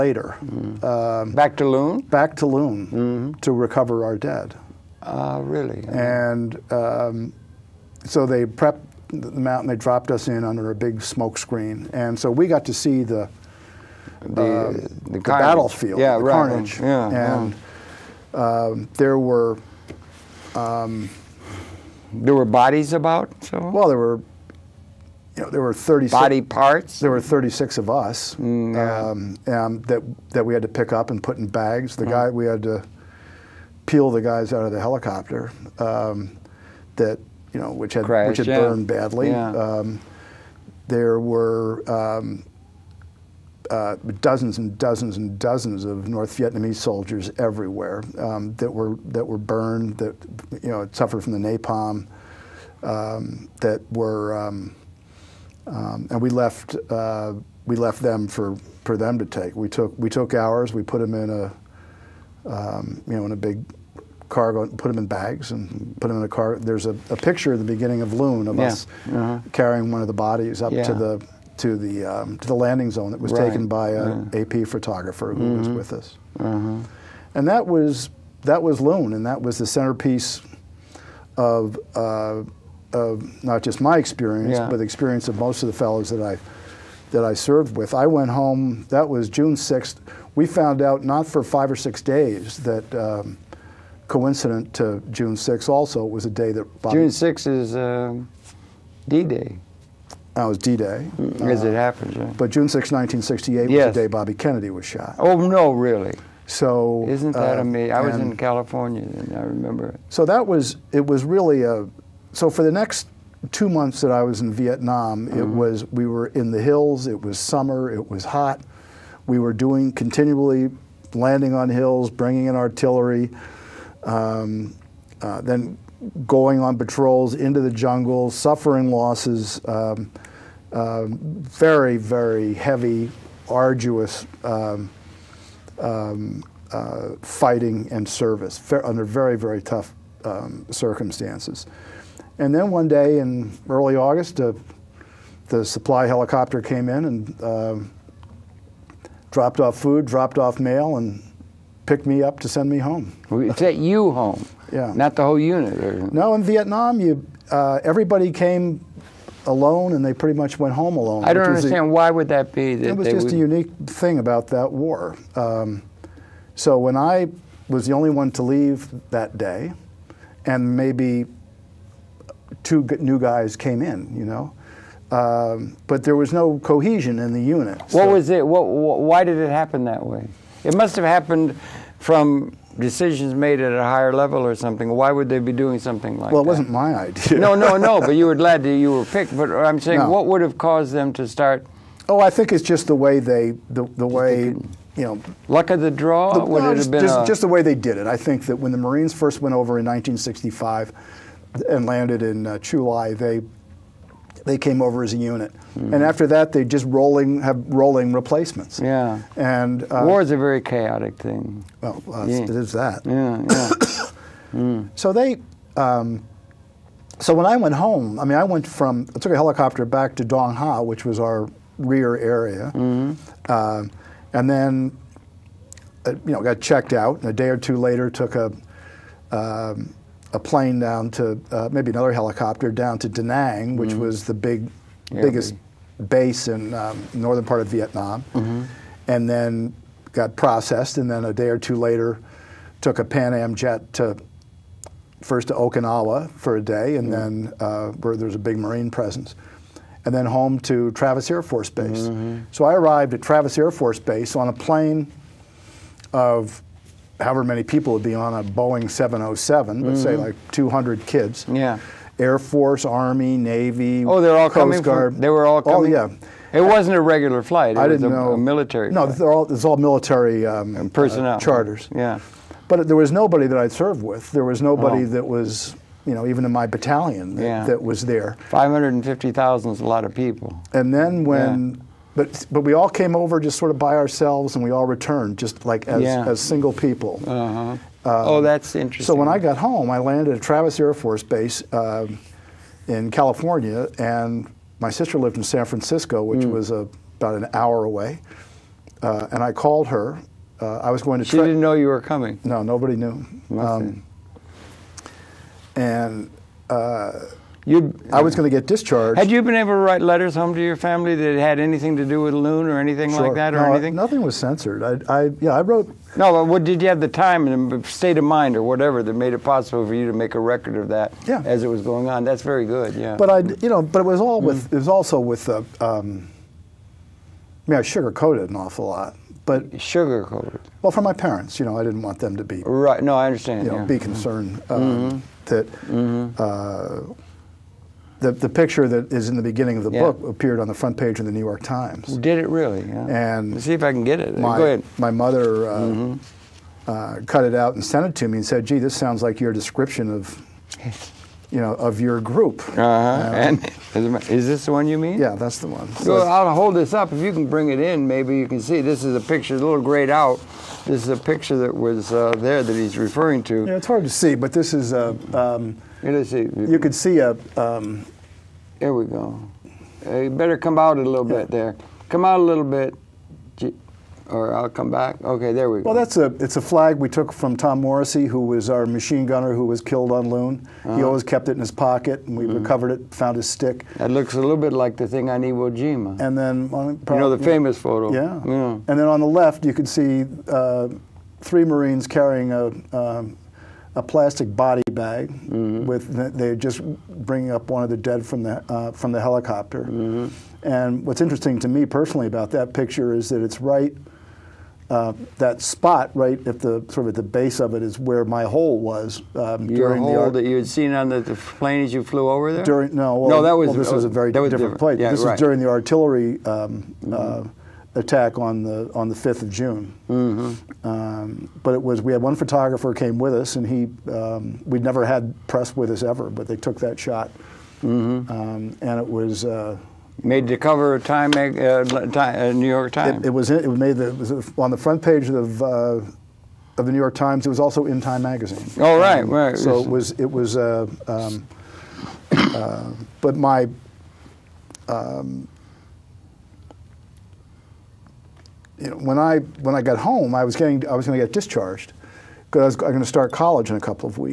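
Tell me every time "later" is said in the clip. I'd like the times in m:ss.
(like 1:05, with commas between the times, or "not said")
3:47, 4:01.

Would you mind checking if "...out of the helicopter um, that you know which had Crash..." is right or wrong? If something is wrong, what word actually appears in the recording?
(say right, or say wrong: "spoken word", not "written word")
right.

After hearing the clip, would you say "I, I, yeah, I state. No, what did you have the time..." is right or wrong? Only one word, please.
wrong.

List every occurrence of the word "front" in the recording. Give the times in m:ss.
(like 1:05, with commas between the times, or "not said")
5:40, 7:14.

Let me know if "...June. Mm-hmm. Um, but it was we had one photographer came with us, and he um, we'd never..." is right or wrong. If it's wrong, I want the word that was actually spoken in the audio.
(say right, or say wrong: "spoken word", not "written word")
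right.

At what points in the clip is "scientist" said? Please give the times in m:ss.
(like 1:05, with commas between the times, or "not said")
not said.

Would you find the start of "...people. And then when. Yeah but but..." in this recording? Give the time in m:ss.
4:40.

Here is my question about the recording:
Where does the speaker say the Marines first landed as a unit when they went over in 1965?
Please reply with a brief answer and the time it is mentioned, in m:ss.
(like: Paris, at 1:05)
Chu Lai, at 3:22.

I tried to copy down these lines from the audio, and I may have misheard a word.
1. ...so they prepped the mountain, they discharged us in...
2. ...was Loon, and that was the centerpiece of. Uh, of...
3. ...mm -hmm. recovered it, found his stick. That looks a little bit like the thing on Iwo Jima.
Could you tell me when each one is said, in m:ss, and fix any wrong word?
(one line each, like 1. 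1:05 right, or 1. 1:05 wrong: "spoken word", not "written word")
1. 0:08 wrong: "dropped", not "discharged"
2. 1:18 right
3. 6:22 right.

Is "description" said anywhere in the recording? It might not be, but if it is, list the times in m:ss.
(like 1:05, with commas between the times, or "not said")
5:49.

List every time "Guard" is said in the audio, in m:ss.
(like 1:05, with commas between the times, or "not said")
4:24.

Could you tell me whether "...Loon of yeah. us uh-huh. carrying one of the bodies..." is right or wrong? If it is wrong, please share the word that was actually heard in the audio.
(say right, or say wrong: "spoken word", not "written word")
right.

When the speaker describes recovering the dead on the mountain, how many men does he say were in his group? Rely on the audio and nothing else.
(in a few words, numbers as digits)
36.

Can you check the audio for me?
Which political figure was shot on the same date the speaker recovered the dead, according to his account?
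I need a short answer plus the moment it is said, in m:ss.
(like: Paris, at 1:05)
Bobby Kennedy, at 1:44.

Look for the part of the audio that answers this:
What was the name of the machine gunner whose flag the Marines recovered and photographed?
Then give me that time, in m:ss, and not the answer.
6:17.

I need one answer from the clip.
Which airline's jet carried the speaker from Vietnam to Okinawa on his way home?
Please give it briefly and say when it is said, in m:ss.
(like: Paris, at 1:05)
Pan Am, at 4:03.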